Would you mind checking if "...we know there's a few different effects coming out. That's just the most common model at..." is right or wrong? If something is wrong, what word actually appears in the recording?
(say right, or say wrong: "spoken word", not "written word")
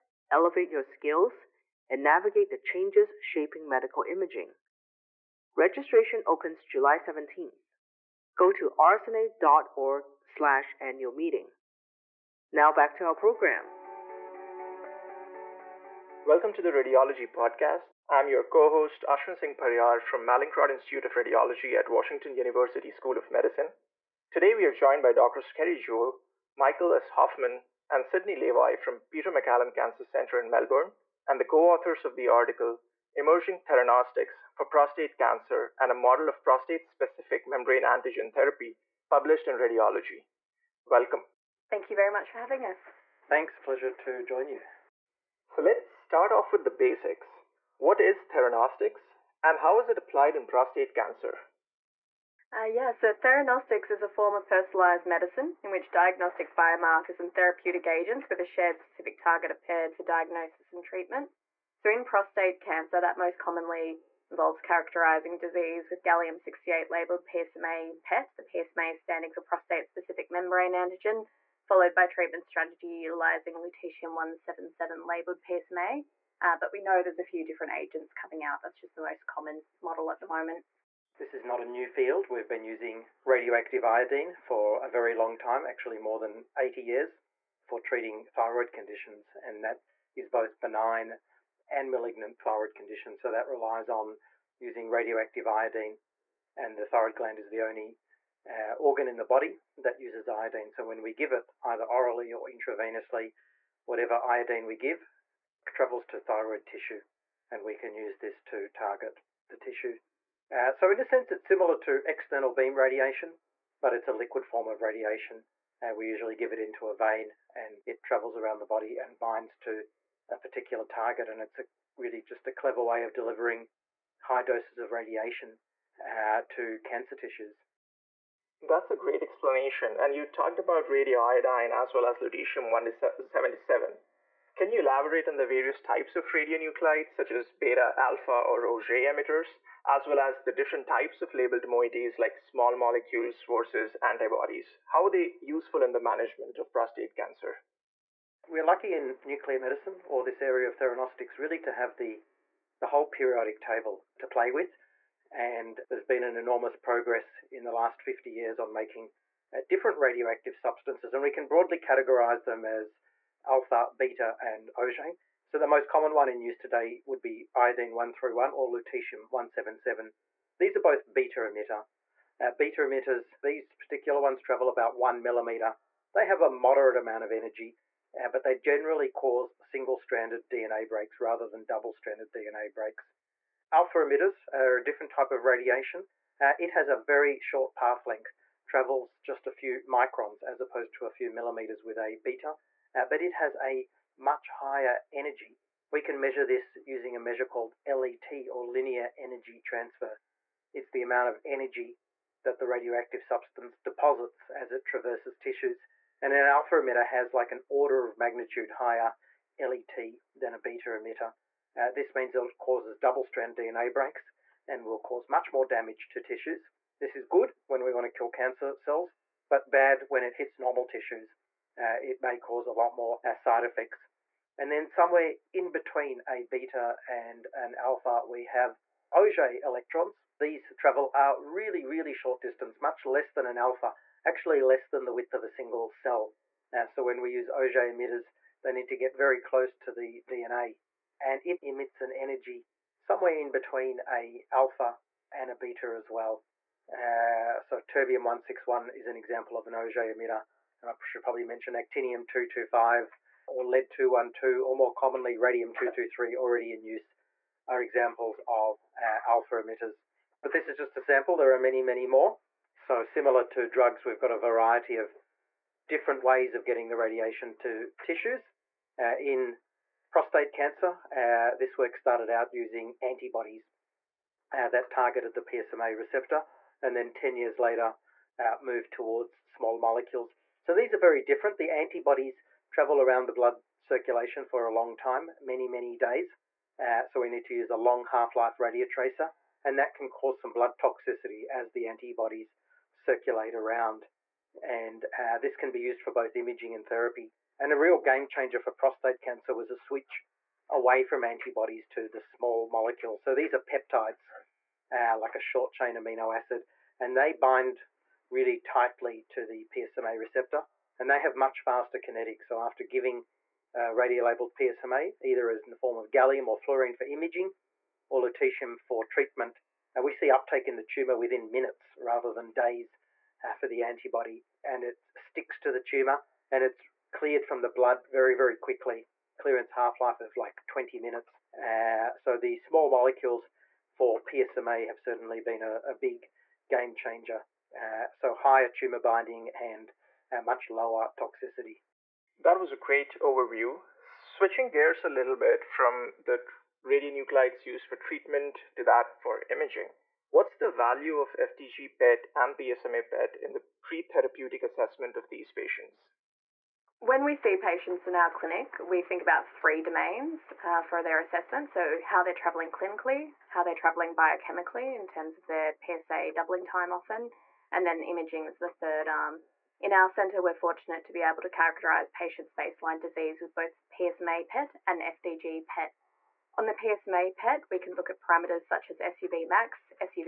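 wrong: "agents", not "effects".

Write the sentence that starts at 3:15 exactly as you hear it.
We can measure this using a measure called LET or linear energy transfer.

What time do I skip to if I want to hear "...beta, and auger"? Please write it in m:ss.
2:43.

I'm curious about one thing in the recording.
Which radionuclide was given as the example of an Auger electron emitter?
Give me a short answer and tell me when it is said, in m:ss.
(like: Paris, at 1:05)
terbium 161, at 4:07.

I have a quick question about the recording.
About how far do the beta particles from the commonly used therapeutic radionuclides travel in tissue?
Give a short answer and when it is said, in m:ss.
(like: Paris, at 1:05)
about 1 millimeter, at 2:54.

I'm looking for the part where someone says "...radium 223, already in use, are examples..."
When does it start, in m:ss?
4:15.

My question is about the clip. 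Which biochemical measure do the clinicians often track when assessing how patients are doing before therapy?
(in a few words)
PSA doubling time.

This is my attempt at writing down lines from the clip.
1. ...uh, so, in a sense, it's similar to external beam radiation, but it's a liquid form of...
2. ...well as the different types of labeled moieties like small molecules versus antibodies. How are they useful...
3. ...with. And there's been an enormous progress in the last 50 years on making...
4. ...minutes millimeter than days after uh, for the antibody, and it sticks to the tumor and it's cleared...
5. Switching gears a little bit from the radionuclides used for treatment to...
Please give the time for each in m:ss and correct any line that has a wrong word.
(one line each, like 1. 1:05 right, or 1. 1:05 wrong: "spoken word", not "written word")
1. 1:50 right
2. 2:20 right
3. 2:34 right
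4. 5:21 wrong: "rather", not "millimeter"
5. 5:43 right.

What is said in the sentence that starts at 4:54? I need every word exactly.
And uh, this can be used for both imaging and therapy.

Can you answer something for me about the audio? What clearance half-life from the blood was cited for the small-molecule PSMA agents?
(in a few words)
20 minutes.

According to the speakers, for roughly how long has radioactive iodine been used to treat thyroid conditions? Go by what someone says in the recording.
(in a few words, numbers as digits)
more than 80 years.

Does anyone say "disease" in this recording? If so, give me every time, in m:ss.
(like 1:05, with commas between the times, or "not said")
1:05, 6:12.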